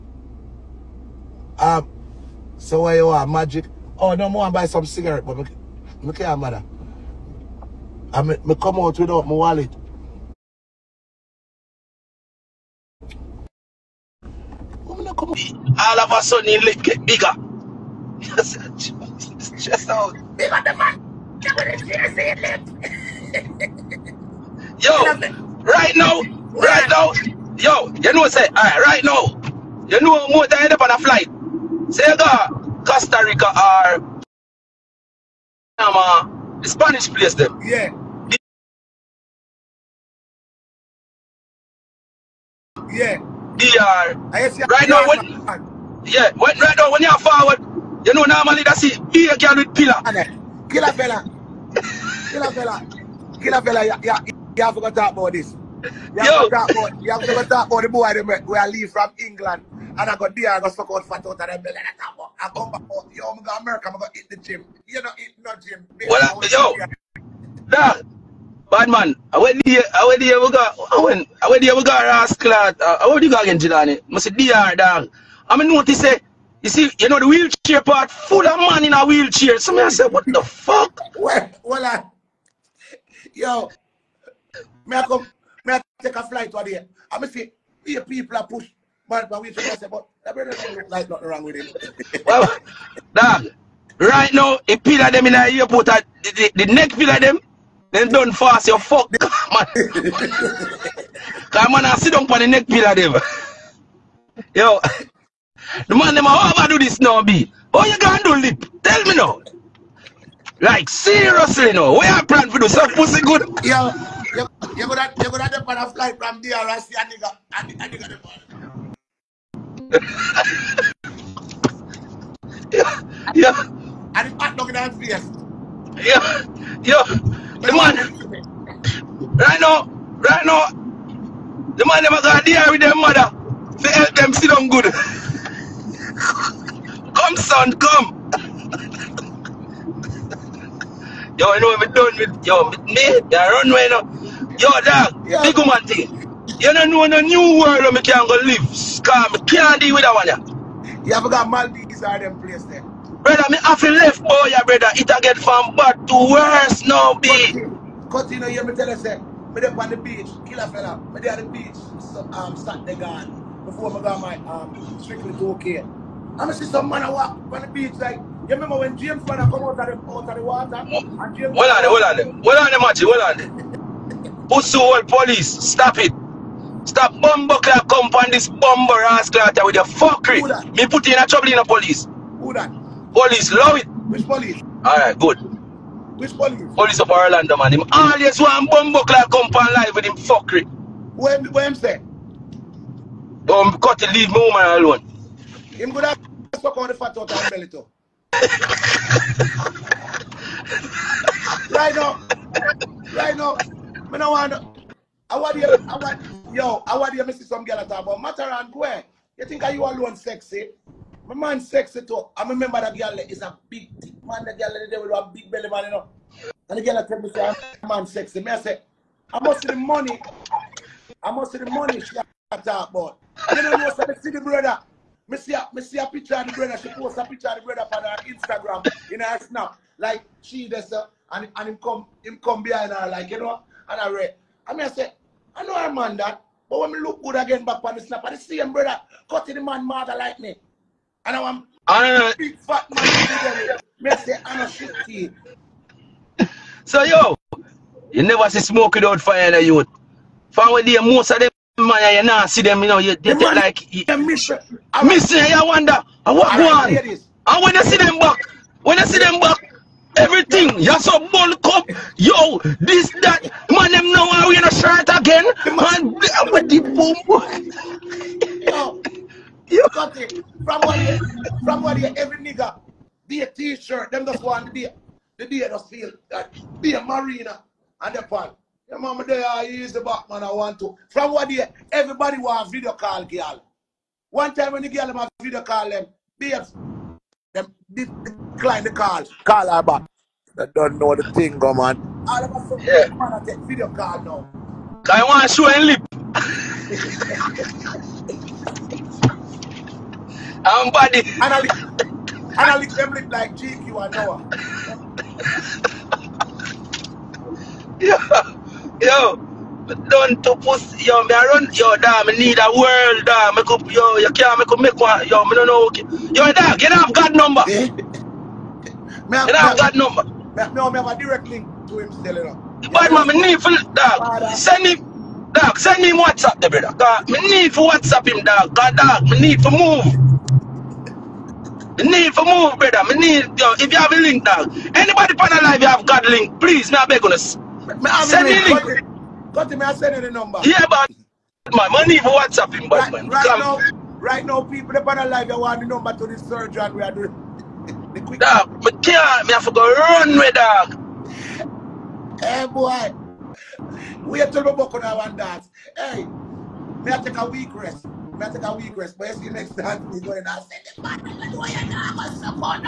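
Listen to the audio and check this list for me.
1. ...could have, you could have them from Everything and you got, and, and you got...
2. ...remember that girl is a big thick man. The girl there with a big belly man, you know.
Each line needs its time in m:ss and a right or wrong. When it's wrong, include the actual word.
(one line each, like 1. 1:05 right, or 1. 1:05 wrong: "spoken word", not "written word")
1. 1:54 wrong: "DRC", not "Everything"
2. 3:32 right.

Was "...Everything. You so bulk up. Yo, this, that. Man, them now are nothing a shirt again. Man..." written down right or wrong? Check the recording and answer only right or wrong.
wrong.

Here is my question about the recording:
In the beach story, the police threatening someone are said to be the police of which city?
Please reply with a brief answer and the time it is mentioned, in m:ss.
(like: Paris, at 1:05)
Orlando, at 3:07.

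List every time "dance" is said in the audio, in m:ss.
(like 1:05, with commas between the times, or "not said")
5:55.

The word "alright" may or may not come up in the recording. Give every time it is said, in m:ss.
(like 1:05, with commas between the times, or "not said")
0:28, 3:04.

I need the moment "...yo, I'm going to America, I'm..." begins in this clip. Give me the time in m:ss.
1:03.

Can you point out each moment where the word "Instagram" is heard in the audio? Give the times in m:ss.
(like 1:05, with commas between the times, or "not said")
3:48.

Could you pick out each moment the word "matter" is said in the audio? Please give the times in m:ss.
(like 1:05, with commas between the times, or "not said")
0:06, 3:28.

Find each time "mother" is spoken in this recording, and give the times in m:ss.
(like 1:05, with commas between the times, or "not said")
2:12, 3:59.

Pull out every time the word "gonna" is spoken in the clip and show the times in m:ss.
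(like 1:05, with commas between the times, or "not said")
0:57, 1:47.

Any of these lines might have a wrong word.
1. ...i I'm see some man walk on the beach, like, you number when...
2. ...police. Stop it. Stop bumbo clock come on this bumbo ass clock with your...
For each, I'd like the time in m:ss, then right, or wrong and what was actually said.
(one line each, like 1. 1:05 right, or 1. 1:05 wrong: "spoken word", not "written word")
1. 2:46 wrong: "remember", not "number"
2. 2:55 right.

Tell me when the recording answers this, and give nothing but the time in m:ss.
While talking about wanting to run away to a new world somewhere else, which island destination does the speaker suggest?
2:31.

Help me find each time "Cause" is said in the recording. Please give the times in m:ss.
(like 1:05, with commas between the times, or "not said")
1:39, 2:29, 5:26.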